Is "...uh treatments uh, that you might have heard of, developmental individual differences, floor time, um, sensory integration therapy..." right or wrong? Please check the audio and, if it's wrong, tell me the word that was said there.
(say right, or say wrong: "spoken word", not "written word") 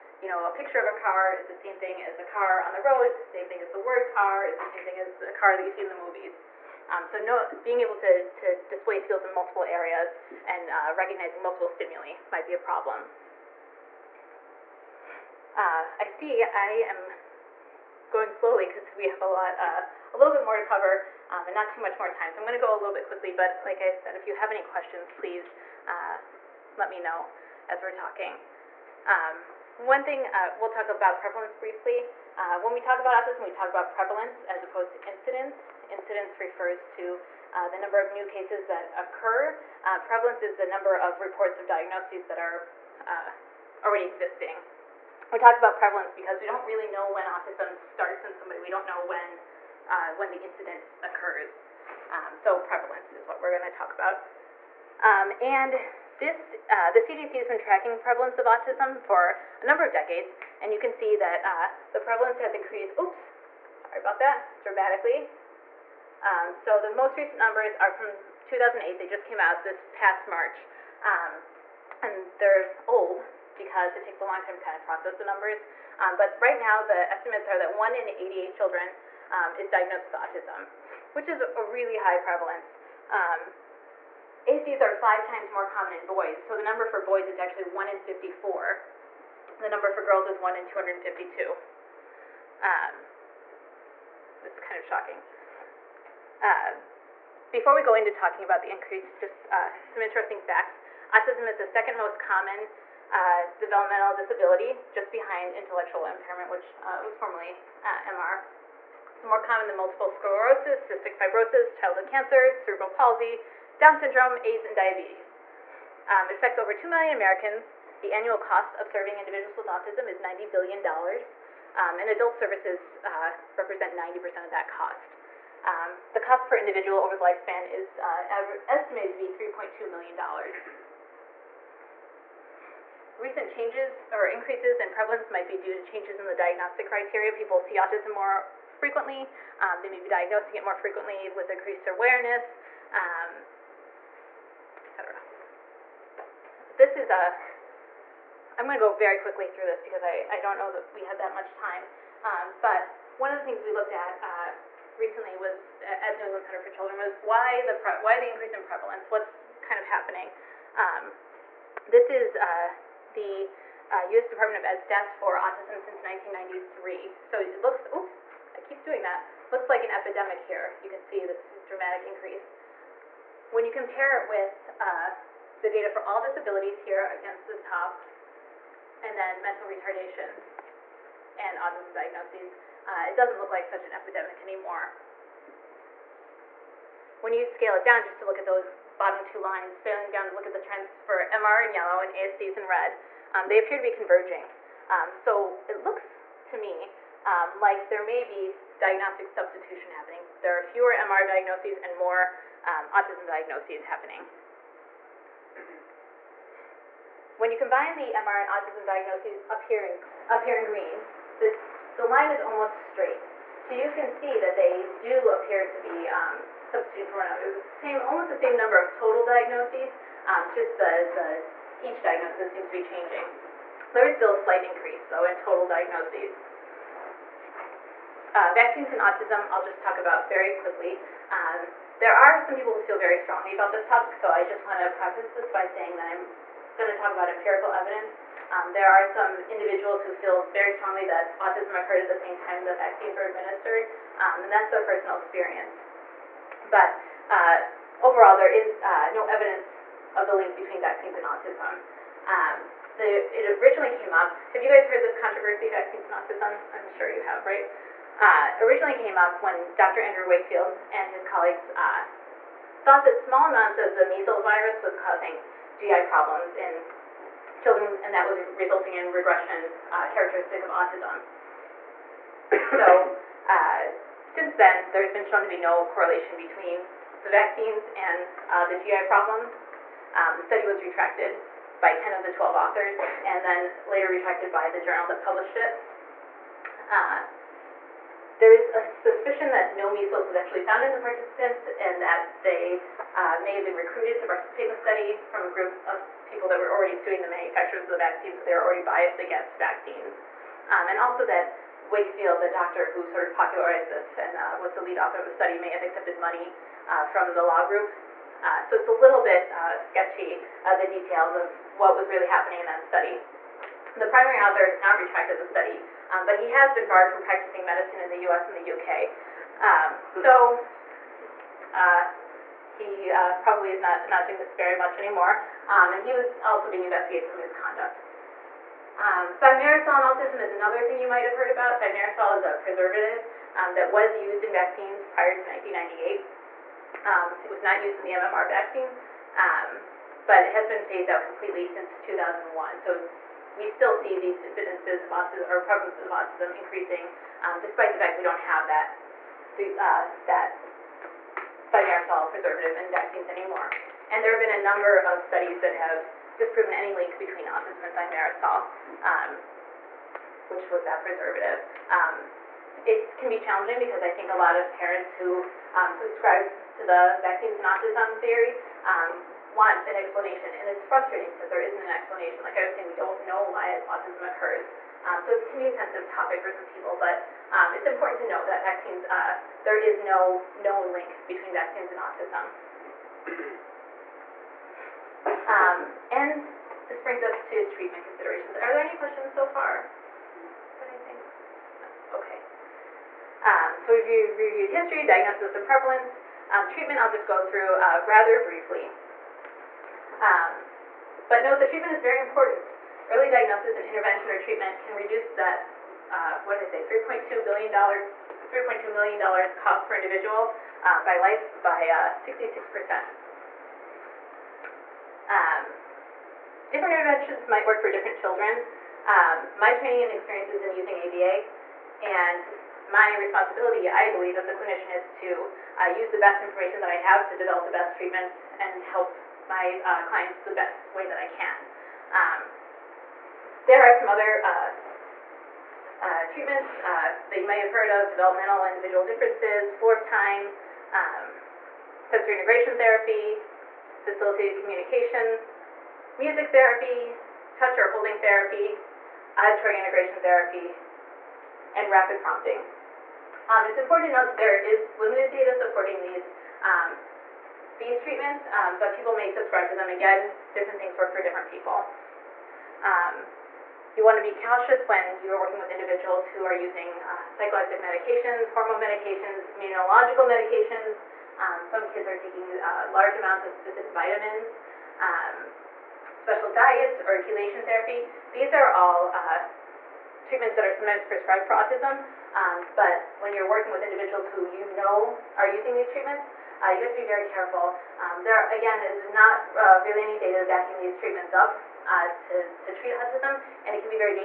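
right.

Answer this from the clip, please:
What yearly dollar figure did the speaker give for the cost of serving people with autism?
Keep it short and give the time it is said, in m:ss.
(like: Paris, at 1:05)
$90 billion, at 2:00.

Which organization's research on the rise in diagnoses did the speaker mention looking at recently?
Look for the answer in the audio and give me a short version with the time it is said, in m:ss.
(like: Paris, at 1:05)
New England Center for Children, at 2:36.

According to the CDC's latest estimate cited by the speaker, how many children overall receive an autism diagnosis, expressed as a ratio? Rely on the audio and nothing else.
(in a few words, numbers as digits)
1 in 88.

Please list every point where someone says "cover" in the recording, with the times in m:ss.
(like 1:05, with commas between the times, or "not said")
0:20.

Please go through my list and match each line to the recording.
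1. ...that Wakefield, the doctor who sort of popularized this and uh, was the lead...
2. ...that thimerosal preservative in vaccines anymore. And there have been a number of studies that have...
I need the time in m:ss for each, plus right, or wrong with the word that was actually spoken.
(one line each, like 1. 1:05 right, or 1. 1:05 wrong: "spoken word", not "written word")
1. 5:01 right
2. 5:50 right.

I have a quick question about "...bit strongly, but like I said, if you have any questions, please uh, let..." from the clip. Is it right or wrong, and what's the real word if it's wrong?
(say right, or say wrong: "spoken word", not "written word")
wrong: "quickly", not "strongly".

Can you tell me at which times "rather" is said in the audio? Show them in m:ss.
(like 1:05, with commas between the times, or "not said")
6:38.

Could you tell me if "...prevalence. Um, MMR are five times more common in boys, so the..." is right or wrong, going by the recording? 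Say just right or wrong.
wrong.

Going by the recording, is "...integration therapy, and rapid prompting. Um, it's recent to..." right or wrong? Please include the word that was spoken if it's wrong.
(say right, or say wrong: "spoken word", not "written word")
wrong: "important", not "recent".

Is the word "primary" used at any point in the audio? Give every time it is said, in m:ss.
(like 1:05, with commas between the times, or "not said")
5:14.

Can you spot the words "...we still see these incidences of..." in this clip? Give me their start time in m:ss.
5:43.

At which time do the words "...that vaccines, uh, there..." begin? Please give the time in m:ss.
6:18.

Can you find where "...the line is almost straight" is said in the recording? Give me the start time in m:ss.
3:31.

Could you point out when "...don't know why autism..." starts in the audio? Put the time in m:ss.
6:12.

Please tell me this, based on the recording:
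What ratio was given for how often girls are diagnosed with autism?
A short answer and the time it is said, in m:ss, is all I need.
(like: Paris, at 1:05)
1 in 252, at 1:30.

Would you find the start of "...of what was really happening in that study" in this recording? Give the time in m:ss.
5:11.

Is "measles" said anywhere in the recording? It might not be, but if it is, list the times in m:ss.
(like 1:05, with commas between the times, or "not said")
4:24, 4:49.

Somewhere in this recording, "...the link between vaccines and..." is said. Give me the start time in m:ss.
4:10.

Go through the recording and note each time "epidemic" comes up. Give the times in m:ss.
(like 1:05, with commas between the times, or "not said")
2:49, 3:03.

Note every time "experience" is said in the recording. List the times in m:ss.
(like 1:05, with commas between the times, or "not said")
4:05, 7:00.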